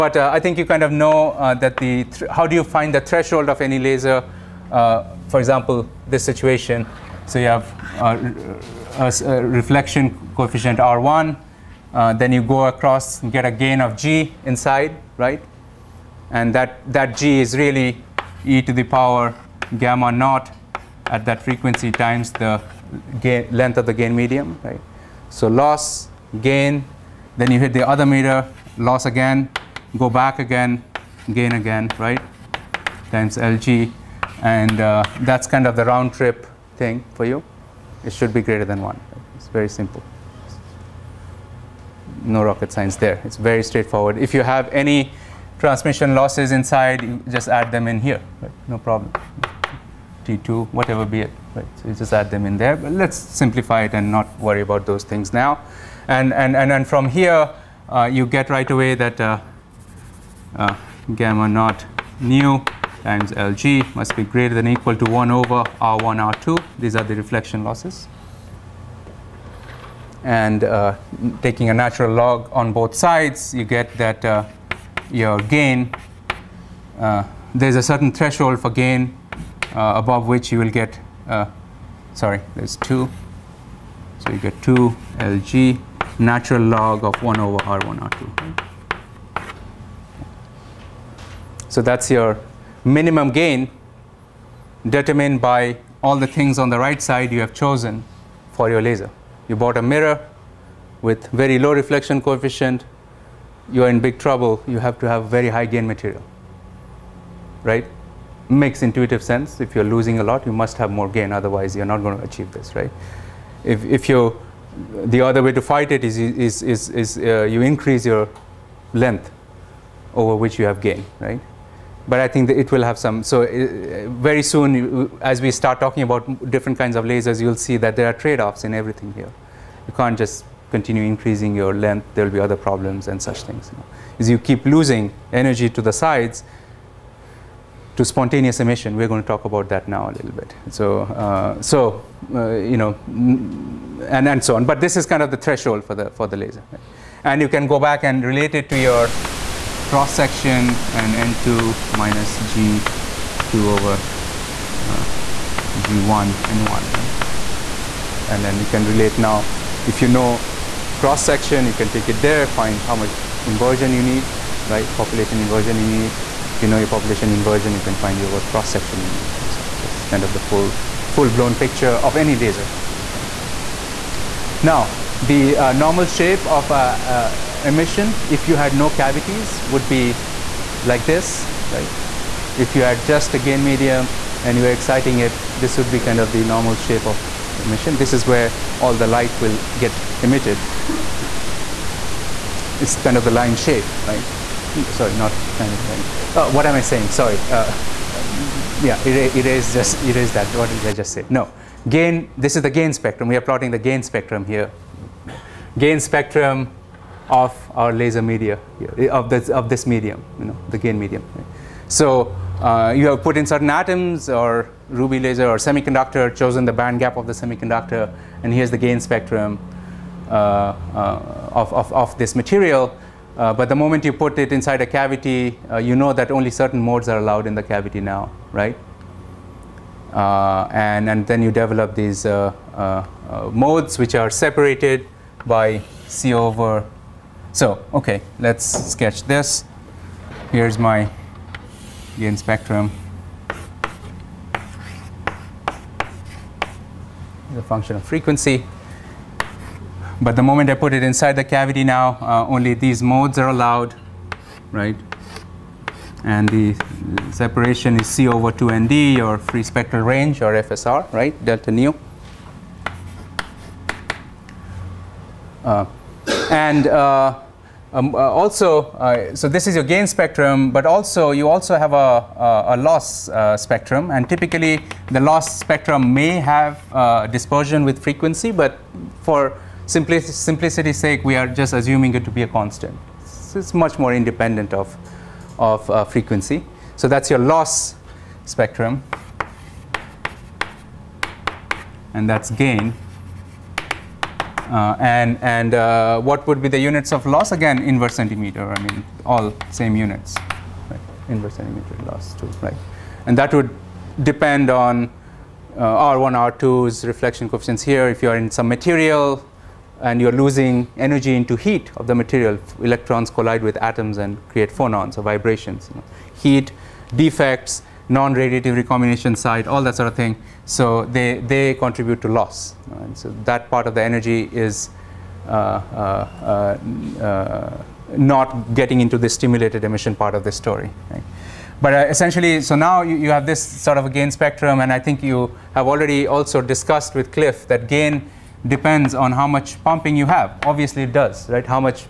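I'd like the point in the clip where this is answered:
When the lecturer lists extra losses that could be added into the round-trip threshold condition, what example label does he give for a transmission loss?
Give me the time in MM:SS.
00:50.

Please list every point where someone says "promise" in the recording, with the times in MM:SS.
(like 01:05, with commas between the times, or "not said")
not said.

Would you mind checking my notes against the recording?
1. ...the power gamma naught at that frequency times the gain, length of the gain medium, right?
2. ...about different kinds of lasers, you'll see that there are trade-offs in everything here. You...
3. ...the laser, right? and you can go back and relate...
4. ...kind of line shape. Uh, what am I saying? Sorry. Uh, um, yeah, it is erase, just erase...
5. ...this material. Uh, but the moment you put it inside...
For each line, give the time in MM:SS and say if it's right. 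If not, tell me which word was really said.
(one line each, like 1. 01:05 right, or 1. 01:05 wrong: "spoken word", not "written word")
1. 00:18 right
2. 02:06 right
3. 02:26 right
4. 03:15 right
5. 03:42 right.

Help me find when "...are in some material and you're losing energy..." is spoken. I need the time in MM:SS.
05:08.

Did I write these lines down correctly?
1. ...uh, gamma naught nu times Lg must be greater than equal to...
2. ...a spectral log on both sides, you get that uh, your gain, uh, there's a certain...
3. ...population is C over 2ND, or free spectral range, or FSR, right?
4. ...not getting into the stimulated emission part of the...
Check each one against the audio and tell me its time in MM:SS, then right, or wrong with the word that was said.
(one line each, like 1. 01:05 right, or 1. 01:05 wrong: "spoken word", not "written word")
1. 01:00 right
2. 01:11 wrong: "natural", not "spectral"
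3. 04:17 wrong: "separation", not "population"
4. 05:28 right.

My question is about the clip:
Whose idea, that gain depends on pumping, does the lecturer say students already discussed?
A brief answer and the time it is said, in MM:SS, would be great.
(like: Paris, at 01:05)
Clif, at 05:37.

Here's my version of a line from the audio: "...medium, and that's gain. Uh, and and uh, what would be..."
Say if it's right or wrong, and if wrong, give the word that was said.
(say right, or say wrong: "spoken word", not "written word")
wrong: "spectrum", not "medium".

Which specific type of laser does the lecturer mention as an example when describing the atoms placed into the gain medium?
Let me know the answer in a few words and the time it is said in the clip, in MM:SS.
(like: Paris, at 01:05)
ruby laser, at 03:34.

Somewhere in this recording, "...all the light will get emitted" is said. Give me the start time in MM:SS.
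03:08.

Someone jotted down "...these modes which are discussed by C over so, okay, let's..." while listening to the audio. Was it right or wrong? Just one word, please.
wrong.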